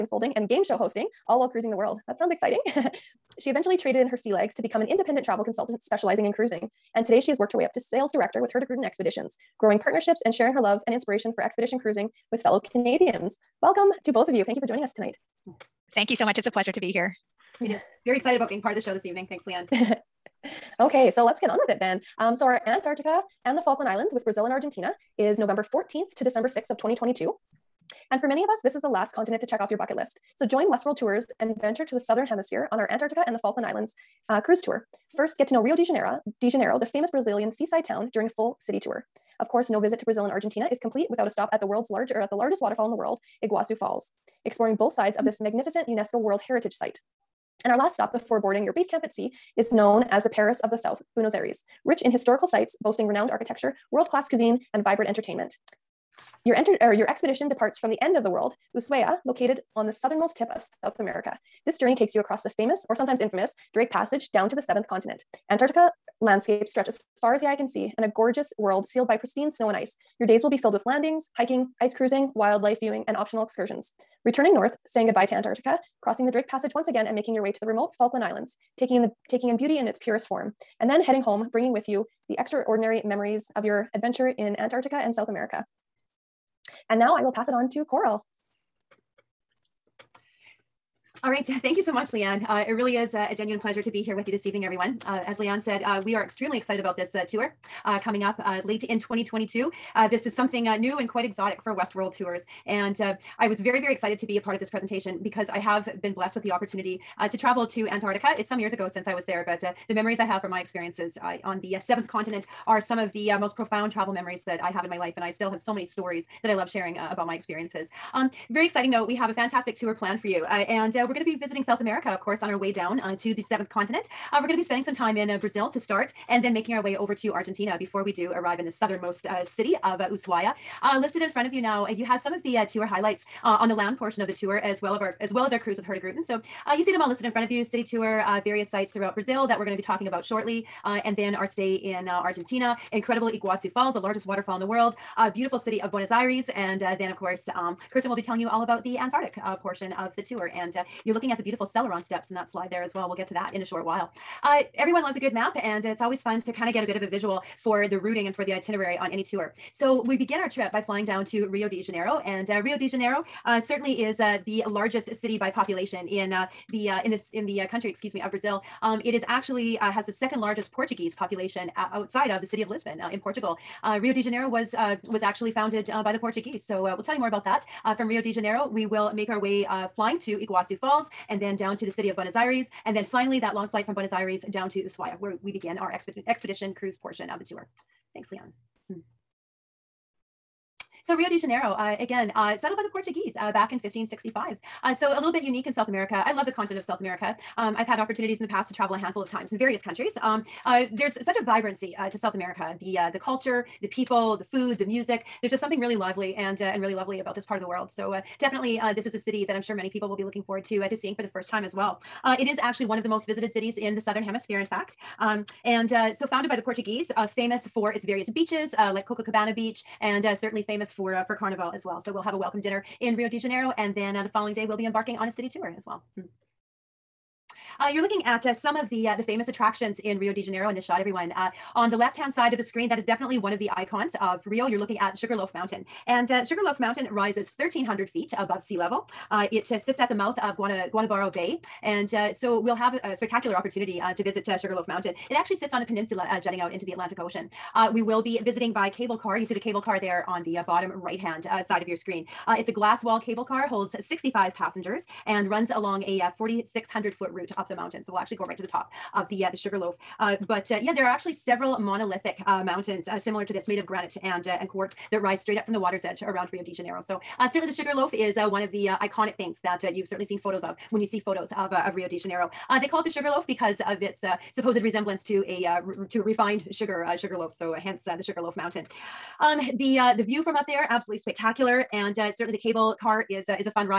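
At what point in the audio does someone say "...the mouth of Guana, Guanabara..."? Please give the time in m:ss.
4:00.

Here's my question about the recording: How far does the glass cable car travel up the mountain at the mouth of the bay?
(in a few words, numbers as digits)
4,600 feet.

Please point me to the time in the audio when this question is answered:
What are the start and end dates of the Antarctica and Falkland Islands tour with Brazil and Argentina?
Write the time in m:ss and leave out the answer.
0:25.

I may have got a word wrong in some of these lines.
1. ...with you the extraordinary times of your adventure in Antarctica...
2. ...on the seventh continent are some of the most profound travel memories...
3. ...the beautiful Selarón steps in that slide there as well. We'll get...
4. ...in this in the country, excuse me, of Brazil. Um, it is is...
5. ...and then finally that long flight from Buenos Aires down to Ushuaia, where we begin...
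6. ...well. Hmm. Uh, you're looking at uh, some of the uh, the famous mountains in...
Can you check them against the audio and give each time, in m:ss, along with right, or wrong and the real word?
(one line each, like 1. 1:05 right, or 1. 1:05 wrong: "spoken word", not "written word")
1. 1:21 wrong: "memories", not "times"
2. 1:51 right
3. 2:31 right
4. 2:47 right
5. 3:02 right
6. 3:45 wrong: "attractions", not "mountains".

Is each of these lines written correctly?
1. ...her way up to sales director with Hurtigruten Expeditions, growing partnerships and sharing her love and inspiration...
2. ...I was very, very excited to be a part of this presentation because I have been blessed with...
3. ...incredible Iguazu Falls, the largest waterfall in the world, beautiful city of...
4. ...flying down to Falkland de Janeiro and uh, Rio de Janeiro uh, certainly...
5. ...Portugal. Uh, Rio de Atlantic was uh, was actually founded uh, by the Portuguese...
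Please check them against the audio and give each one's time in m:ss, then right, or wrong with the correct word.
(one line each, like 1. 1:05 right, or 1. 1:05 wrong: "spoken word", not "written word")
1. 0:07 right
2. 1:43 right
3. 2:22 right
4. 2:40 wrong: "Rio", not "Falkland"
5. 2:53 wrong: "Janeiro", not "Atlantic".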